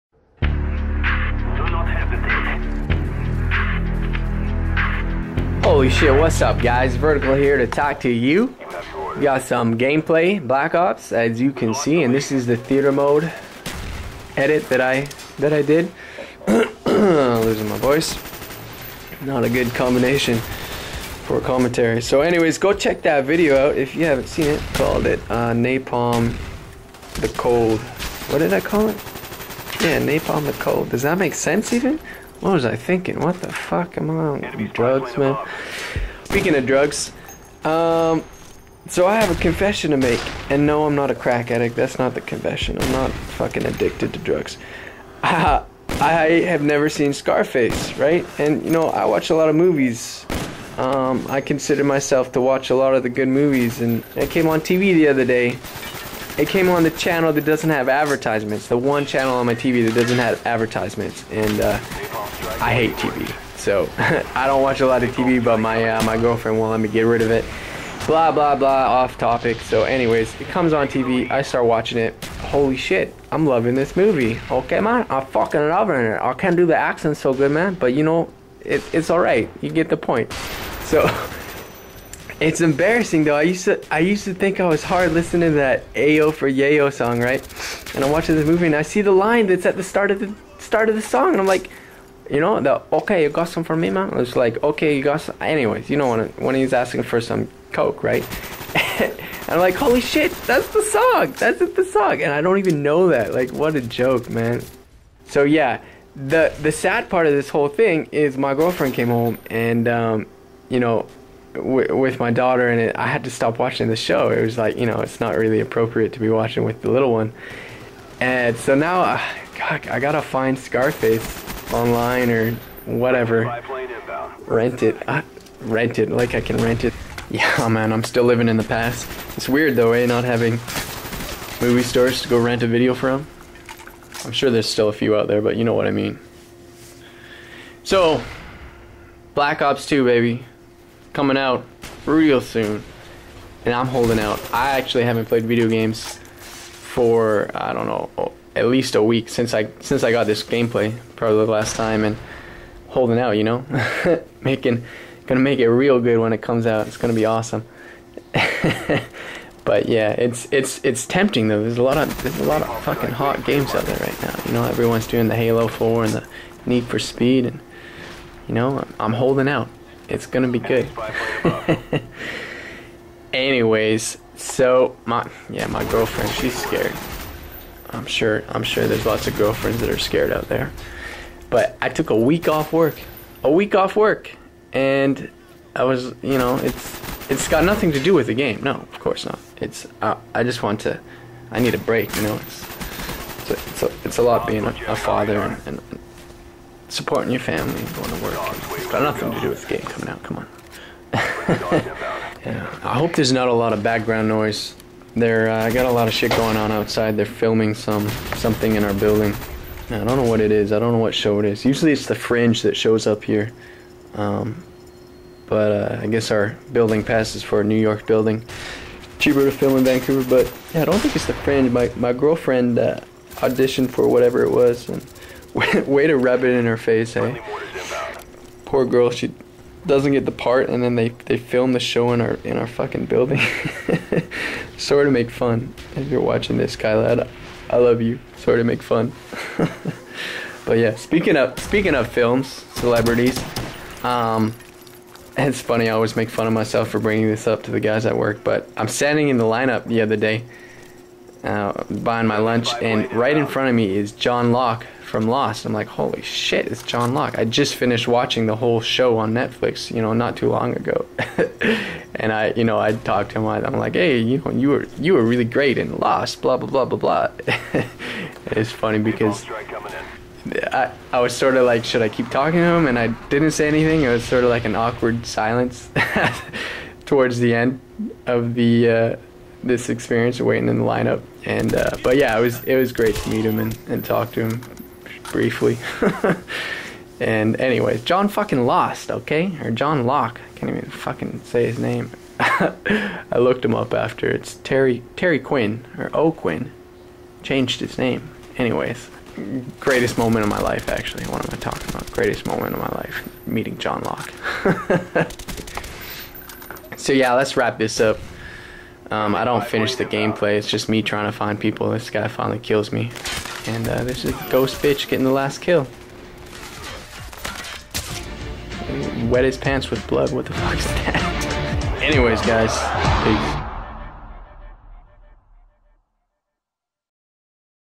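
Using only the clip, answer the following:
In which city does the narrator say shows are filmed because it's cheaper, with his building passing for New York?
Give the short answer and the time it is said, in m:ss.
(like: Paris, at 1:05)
Vancouver, at 3:39.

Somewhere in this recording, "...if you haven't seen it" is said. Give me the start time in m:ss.
0:23.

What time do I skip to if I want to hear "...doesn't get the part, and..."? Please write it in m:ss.
3:49.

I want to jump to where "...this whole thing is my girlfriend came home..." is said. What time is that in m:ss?
1:47.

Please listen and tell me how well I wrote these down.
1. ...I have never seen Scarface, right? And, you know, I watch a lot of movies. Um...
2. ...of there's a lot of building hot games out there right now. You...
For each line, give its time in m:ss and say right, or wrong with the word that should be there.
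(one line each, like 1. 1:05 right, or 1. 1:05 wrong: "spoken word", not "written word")
1. 0:45 right
2. 2:41 wrong: "fucking", not "building".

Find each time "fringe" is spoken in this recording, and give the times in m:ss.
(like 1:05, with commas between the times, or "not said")
3:32, 3:41.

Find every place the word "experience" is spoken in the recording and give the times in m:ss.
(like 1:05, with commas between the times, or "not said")
4:39.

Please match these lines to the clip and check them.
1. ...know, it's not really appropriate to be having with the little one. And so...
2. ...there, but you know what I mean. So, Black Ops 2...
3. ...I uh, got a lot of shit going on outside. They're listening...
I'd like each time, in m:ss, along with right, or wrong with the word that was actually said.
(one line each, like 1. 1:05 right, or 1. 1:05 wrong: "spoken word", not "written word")
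1. 1:54 wrong: "watching", not "having"
2. 2:15 right
3. 3:25 wrong: "filming", not "listening".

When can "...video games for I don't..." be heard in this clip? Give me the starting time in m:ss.
2:25.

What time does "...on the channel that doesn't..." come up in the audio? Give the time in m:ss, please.
0:56.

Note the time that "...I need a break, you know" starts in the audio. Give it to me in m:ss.
3:11.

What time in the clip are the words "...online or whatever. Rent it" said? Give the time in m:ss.
2:01.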